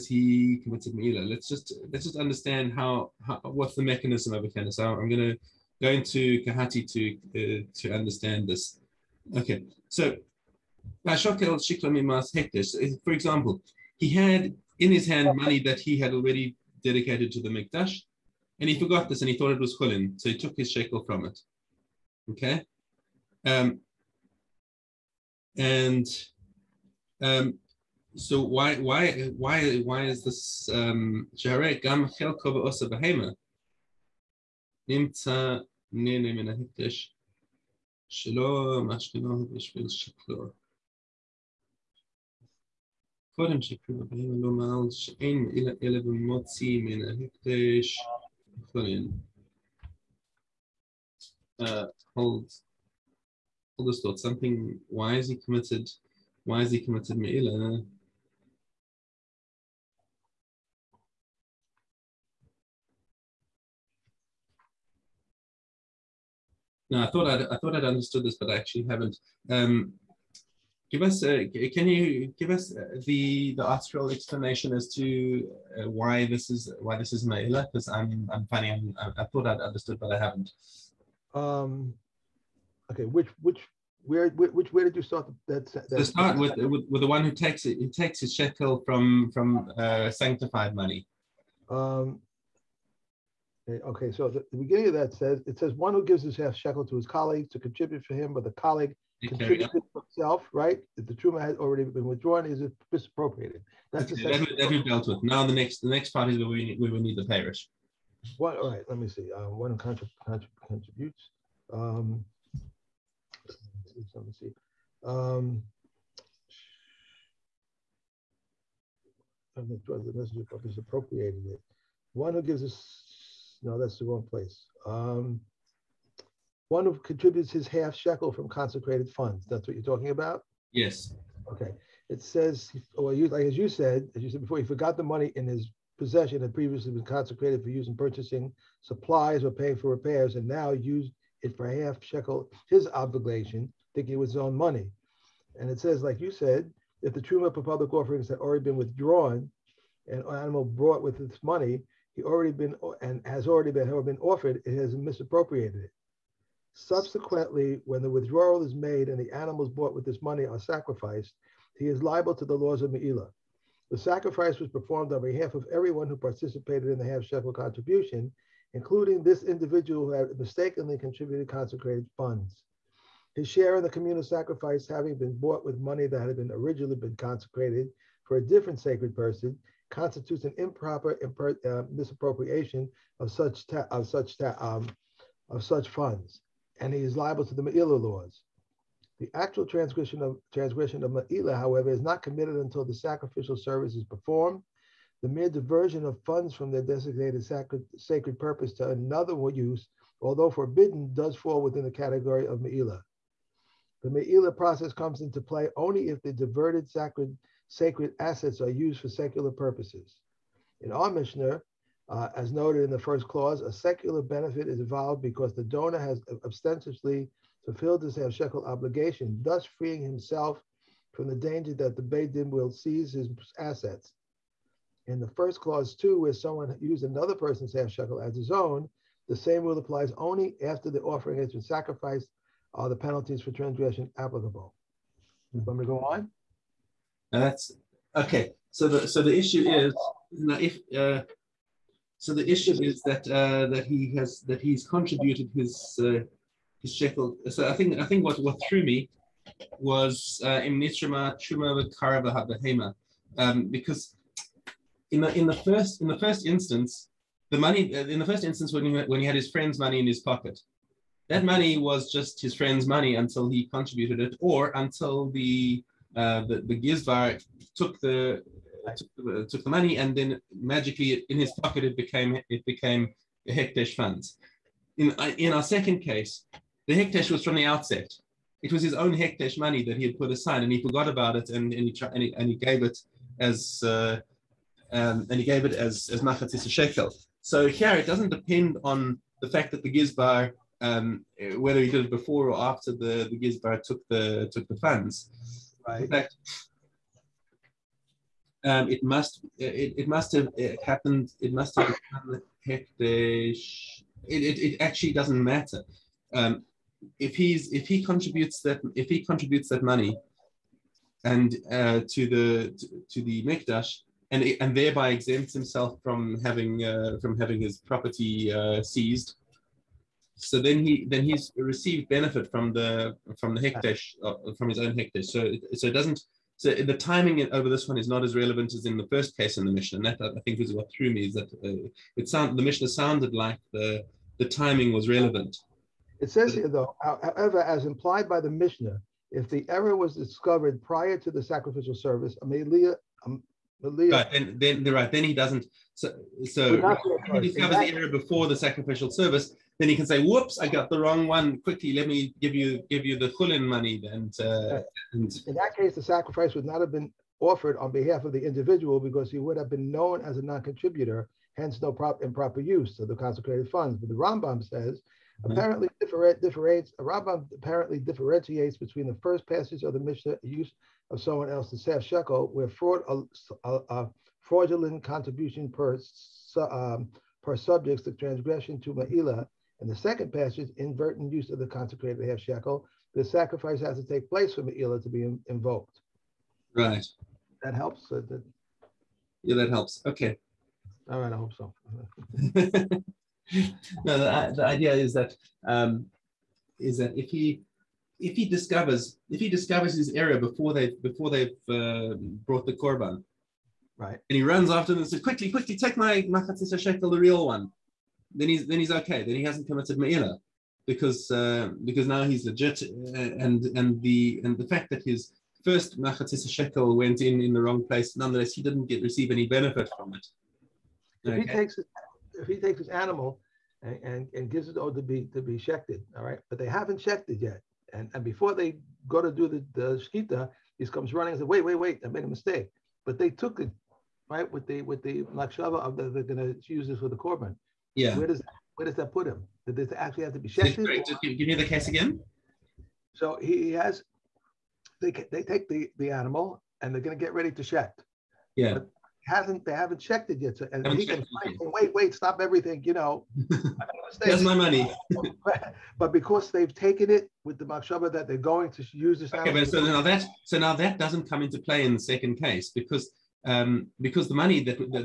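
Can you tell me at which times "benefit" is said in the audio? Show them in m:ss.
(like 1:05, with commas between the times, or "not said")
3:34, 5:22, 6:59.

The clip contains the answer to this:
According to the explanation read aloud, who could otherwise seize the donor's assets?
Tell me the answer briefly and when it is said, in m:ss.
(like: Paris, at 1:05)
The Beidim, at 3:42.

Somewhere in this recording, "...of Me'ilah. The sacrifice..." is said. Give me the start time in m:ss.
2:42.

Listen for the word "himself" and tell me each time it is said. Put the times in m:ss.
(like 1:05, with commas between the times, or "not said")
1:39, 3:40, 5:15.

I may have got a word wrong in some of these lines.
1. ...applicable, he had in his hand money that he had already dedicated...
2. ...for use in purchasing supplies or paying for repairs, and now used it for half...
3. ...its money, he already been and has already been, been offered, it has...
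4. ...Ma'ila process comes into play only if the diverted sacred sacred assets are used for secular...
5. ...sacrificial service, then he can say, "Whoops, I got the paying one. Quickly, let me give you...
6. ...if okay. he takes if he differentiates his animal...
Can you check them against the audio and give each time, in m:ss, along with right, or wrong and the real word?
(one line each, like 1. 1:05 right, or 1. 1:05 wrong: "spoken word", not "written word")
1. 0:13 wrong: "example", not "applicable"
2. 2:17 right
3. 2:31 right
4. 3:24 right
5. 5:48 wrong: "wrong", not "paying"
6. 7:01 wrong: "takes", not "differentiates".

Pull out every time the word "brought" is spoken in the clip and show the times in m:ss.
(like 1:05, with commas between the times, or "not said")
2:30, 6:42.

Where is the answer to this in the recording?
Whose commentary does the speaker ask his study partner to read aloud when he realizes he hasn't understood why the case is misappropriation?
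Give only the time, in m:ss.
1:13.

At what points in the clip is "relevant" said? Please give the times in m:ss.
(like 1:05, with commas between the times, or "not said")
5:28, 5:35.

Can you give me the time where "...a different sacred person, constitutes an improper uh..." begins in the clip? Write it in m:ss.
2:58.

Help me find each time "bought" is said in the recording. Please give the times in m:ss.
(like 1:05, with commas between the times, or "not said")
2:39, 2:55.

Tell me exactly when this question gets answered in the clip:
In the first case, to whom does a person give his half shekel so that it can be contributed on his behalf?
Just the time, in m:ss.
1:36.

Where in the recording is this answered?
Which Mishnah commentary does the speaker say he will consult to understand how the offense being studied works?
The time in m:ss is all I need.
0:06.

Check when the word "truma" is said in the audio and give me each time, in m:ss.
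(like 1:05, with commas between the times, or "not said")
1:41, 2:27, 4:11.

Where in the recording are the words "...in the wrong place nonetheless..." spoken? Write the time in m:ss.
6:57.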